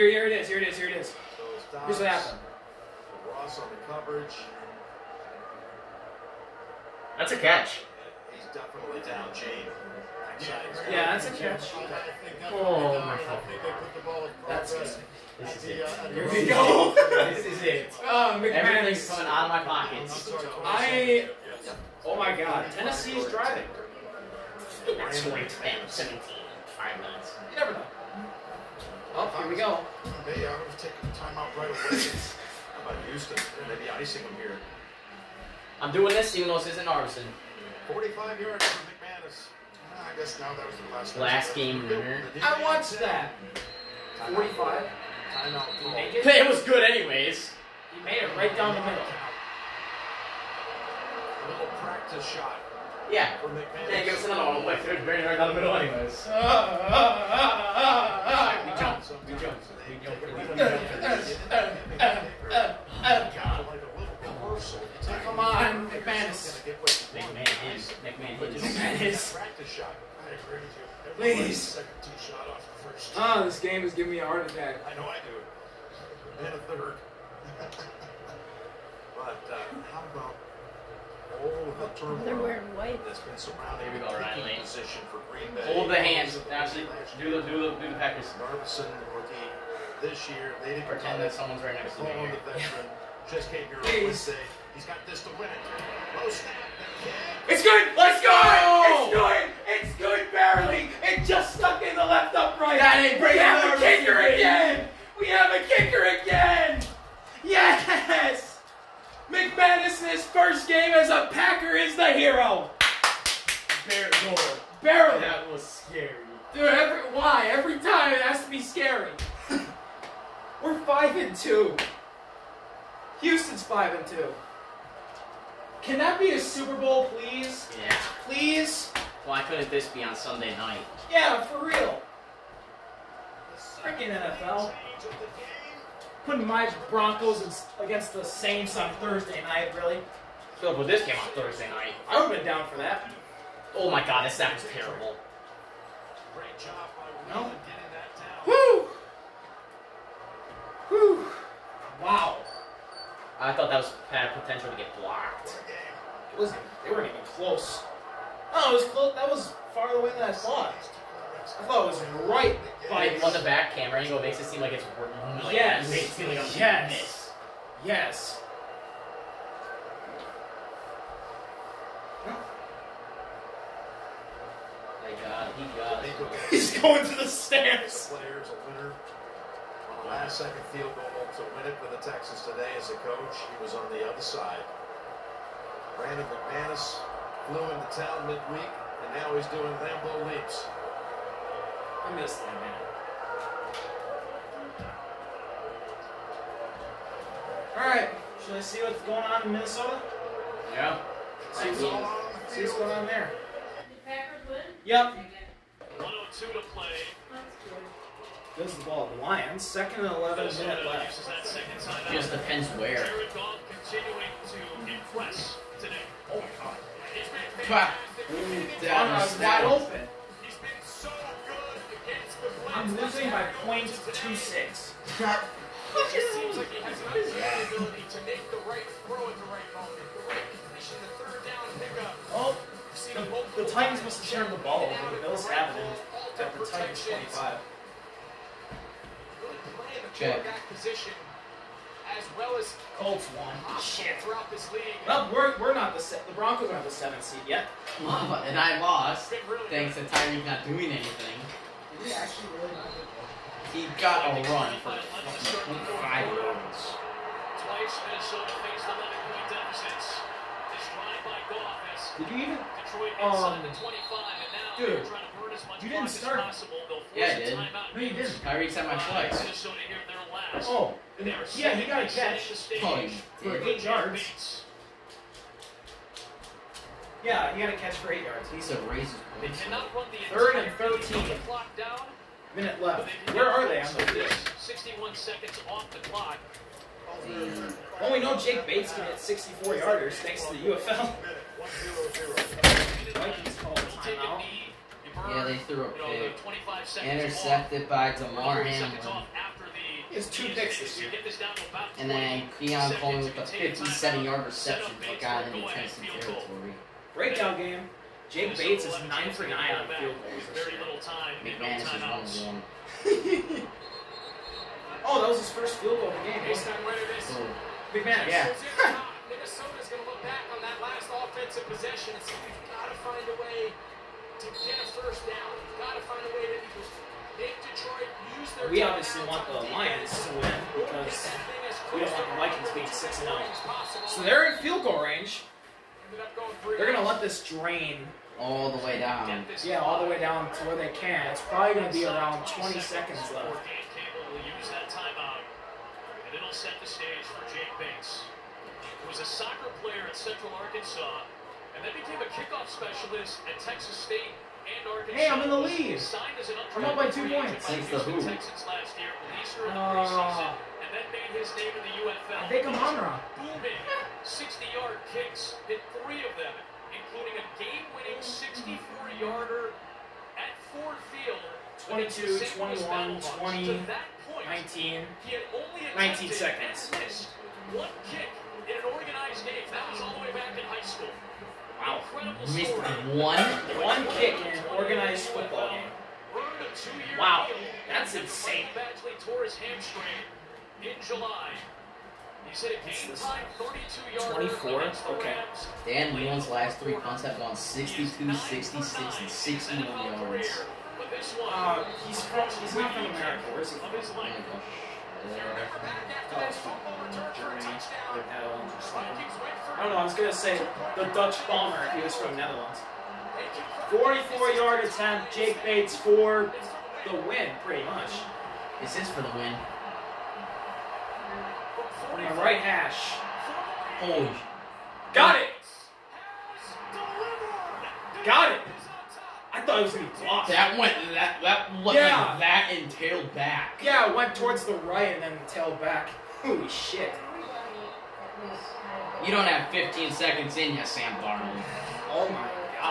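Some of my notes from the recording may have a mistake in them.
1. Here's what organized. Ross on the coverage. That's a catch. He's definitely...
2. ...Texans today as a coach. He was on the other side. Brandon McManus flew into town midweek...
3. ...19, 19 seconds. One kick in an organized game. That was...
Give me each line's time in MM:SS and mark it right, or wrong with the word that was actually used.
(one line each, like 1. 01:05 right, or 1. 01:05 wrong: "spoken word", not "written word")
1. 00:01 wrong: "happened", not "organized"
2. 03:02 right
3. 06:14 right.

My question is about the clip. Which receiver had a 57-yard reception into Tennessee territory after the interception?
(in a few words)
Keon Coleman.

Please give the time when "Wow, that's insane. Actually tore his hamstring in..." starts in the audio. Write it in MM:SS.
06:27.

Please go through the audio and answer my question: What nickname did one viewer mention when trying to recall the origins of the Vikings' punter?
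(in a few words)
the Dutch bomber.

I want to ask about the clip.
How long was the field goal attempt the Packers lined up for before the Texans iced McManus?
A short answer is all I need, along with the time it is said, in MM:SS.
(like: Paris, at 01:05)
45 yards, at 00:37.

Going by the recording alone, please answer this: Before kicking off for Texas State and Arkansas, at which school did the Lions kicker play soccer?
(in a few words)
Central Arkansas.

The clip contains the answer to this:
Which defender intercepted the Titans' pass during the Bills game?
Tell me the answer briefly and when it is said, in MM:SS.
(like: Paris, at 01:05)
Damar Hamlin, at 04:58.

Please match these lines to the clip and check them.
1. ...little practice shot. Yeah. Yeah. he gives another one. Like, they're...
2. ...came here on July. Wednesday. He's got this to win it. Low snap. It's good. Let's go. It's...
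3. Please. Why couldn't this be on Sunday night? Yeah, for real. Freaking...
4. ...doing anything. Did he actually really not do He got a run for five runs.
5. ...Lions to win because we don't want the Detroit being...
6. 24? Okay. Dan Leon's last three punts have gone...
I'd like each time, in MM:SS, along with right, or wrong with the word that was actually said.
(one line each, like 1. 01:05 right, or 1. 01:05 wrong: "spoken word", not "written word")
1. 00:51 right
2. 01:33 wrong: "Please", not "July"
3. 02:08 right
4. 04:10 right
5. 05:29 wrong: "Vikings", not "Detroit"
6. 06:35 right.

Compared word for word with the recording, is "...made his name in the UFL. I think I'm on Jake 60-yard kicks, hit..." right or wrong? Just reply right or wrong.
wrong.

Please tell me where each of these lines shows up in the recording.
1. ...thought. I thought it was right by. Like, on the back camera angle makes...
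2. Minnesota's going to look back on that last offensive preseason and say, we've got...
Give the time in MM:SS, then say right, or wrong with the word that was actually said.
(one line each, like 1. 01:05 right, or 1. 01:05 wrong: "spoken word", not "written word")
1. 02:40 right
2. 05:19 wrong: "possession", not "preseason".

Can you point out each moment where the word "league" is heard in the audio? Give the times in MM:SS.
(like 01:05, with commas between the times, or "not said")
04:04.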